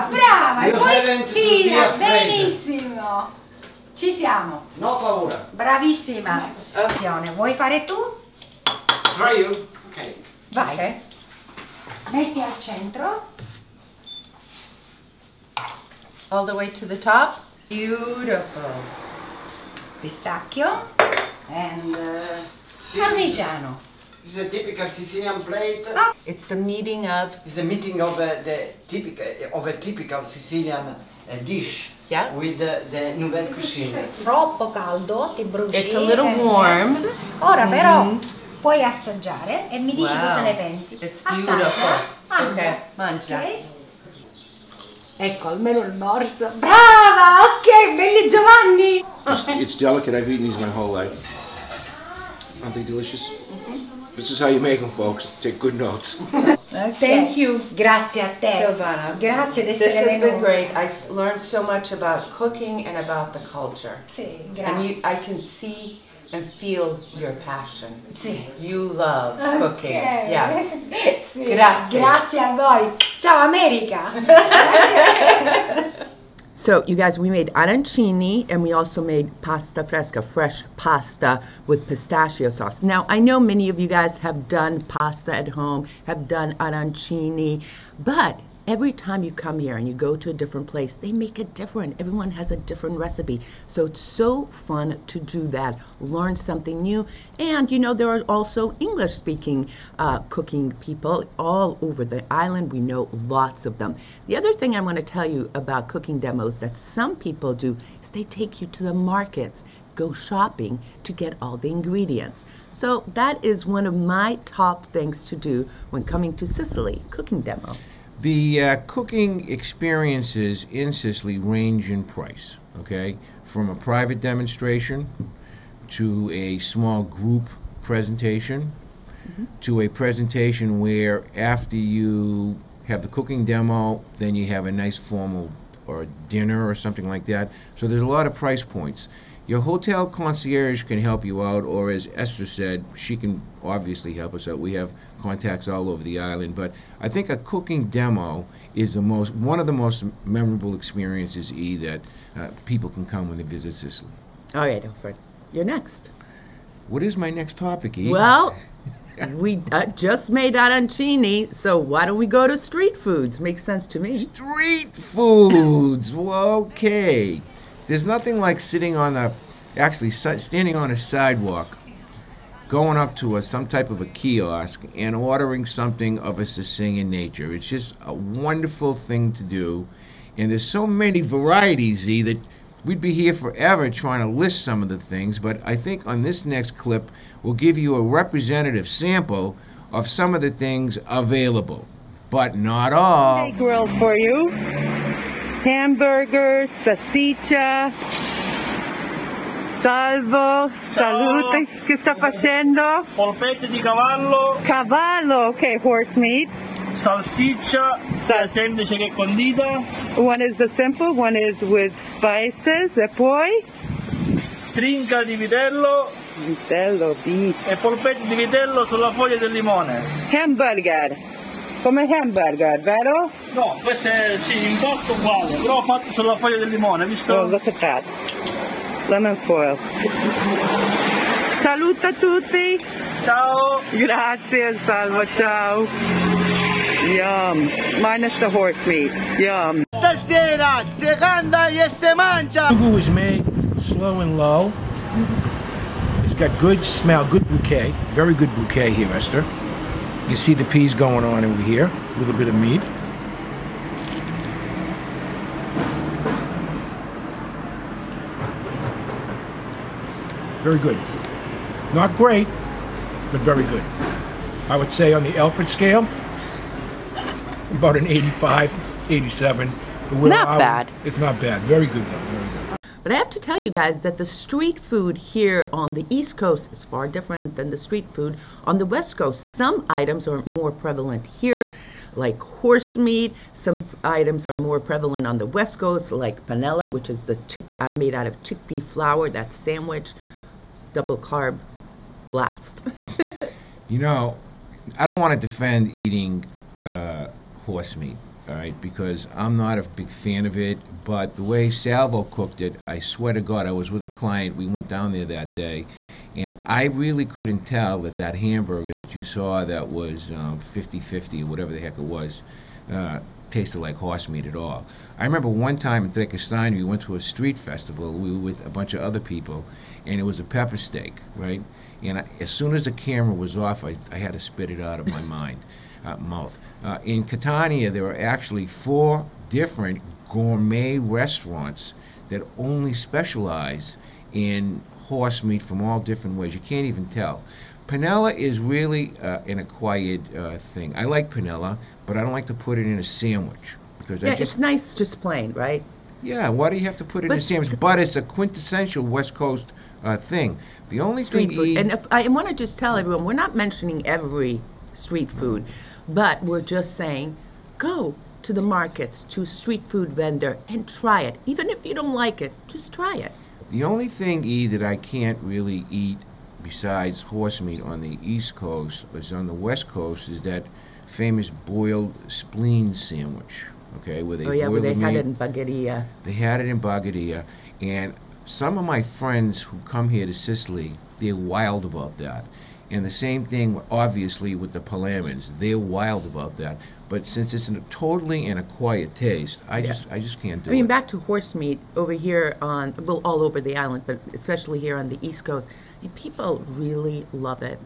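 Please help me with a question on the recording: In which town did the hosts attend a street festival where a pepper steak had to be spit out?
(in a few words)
Trecastagni.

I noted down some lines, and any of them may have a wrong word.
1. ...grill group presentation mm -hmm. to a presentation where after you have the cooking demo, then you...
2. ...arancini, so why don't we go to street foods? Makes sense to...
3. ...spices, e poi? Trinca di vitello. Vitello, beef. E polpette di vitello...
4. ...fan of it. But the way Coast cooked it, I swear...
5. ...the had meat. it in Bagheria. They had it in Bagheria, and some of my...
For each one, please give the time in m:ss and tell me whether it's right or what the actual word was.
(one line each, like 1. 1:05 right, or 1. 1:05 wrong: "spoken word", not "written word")
1. 2:06 wrong: "small", not "grill"
2. 2:40 right
3. 3:31 right
4. 5:00 wrong: "Salvo", not "Coast"
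5. 6:14 right.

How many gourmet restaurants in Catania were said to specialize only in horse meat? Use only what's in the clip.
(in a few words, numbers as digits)
4.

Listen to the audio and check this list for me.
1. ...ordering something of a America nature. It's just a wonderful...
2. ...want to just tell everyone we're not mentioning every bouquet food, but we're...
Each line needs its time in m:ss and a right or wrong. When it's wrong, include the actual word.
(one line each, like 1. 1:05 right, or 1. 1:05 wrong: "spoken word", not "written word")
1. 2:55 wrong: "Sicilian", not "America"
2. 5:52 wrong: "street", not "bouquet".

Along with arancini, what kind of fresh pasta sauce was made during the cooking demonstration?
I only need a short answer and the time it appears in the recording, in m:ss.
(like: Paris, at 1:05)
Pistachio sauce, at 1:21.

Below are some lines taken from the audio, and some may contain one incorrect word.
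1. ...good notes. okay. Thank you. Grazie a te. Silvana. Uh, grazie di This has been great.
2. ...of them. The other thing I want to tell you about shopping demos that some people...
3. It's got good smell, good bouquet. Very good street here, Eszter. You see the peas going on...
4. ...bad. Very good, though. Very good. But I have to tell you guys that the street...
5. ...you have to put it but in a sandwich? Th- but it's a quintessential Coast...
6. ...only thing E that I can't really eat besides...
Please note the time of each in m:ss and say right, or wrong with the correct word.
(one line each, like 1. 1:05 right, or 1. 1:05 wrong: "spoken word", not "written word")
1. 0:55 right
2. 1:43 wrong: "cooking", not "shopping"
3. 4:06 wrong: "bouquet", not "street"
4. 4:31 right
5. 5:46 wrong: "West", not "Coast"
6. 6:03 right.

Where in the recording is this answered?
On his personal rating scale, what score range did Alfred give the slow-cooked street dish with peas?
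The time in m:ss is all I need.
4:27.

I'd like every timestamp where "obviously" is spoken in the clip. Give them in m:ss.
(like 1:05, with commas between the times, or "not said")
2:23, 6:23.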